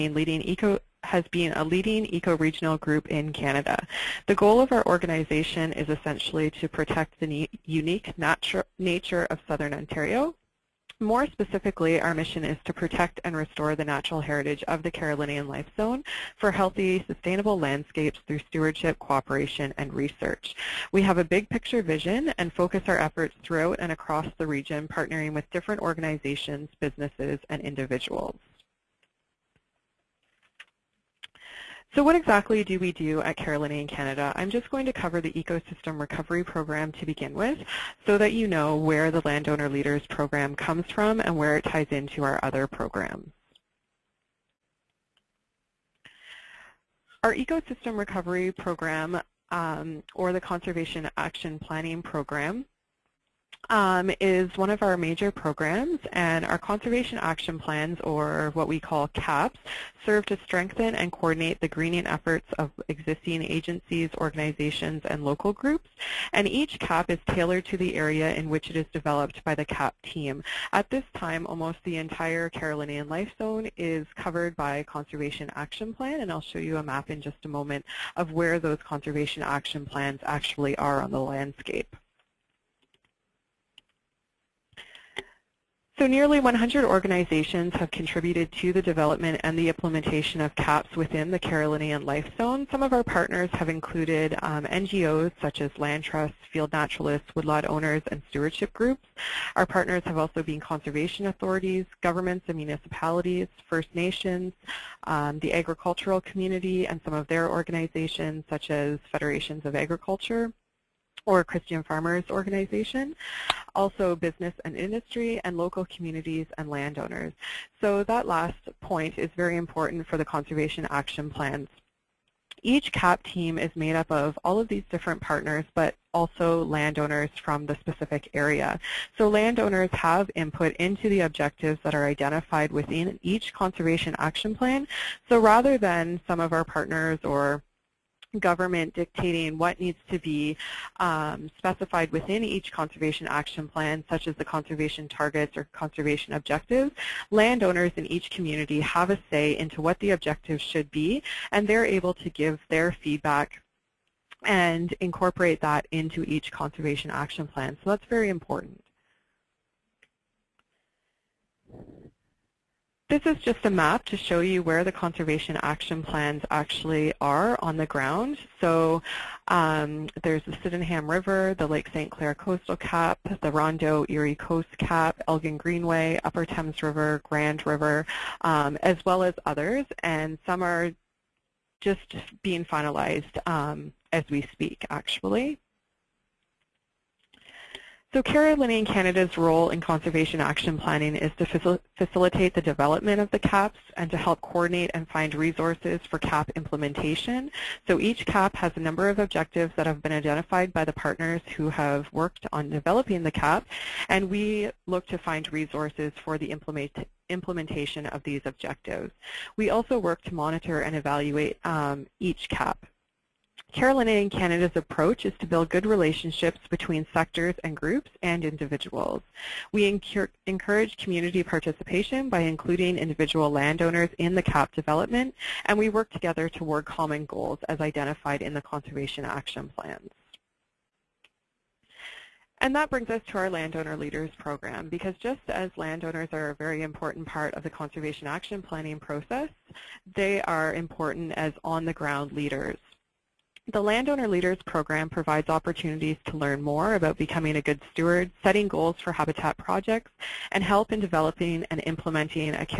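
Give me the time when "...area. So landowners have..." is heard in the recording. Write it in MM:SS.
02:08.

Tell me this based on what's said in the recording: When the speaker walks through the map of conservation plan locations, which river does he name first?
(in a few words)
Sydenham River.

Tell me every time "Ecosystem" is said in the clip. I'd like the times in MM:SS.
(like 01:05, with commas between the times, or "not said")
00:35, 00:47.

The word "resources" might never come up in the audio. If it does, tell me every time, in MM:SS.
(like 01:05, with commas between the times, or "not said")
03:15, 03:25.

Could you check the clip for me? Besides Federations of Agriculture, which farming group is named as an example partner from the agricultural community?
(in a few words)
Christian Farmers Organization.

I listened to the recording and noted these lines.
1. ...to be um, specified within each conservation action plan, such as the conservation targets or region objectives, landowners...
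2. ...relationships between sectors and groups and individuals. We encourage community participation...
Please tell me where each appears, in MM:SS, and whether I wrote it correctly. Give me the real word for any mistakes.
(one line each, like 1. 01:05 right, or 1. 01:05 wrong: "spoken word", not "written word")
1. 02:20 wrong: "conservation", not "region"
2. 03:35 right.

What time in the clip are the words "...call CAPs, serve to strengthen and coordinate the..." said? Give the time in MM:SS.
00:58.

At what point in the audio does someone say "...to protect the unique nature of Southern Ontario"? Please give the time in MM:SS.
00:06.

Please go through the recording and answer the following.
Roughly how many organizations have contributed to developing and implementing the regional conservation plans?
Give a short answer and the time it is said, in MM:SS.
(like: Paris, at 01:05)
nearly 100, at 01:26.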